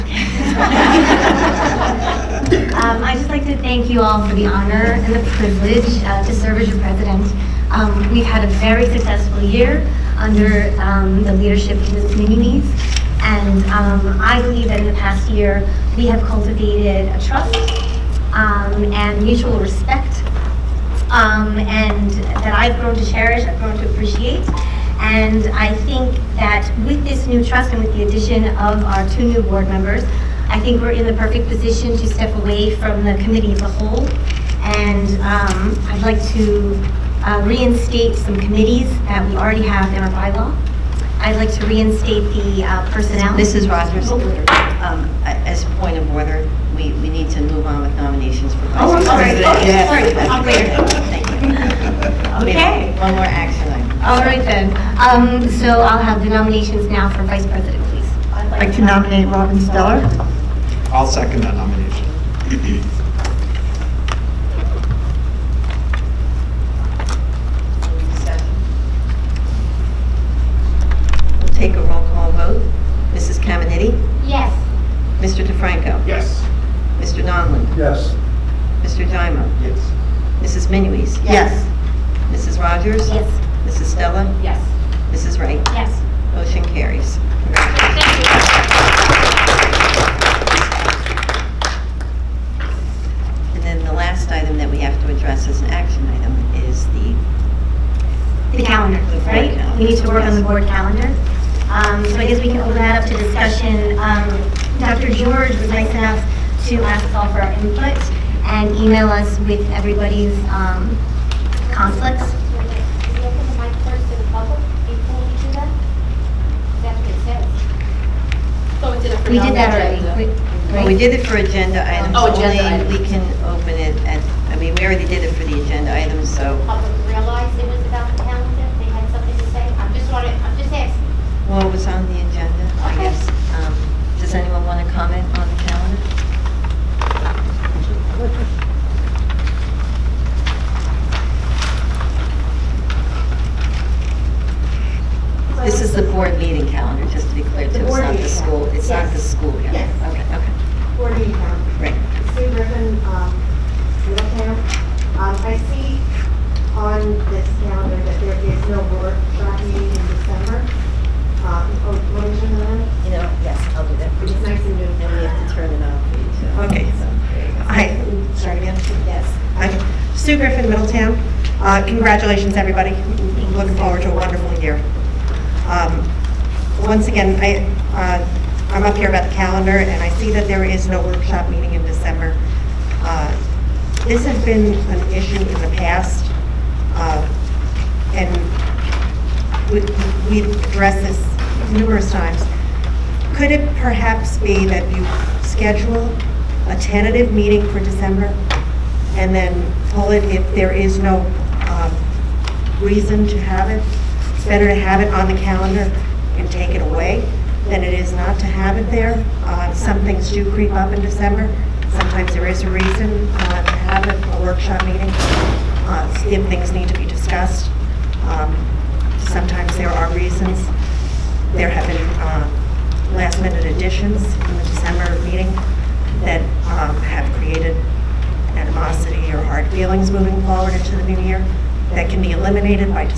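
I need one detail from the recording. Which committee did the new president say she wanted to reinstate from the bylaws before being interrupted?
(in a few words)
personnel.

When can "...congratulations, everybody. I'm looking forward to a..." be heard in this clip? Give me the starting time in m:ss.
2:52.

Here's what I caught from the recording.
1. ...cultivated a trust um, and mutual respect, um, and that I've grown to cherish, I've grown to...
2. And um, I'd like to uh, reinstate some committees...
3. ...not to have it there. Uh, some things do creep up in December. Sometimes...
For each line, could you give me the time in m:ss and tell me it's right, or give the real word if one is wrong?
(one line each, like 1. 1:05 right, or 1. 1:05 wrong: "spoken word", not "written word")
1. 0:16 right
2. 0:34 right
3. 3:28 right.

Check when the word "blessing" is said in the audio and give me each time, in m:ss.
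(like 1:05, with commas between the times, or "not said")
not said.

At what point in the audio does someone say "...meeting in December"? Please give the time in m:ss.
3:01.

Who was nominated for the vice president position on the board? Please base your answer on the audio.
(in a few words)
Robin Stella.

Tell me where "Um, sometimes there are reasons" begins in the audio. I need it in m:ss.
3:38.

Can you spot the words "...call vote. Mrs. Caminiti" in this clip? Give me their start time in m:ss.
1:12.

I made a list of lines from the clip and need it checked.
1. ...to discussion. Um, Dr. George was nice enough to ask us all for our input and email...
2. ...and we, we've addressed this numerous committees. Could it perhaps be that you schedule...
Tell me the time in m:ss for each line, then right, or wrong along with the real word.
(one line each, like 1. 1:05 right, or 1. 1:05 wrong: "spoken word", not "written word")
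1. 1:43 right
2. 3:08 wrong: "times", not "committees".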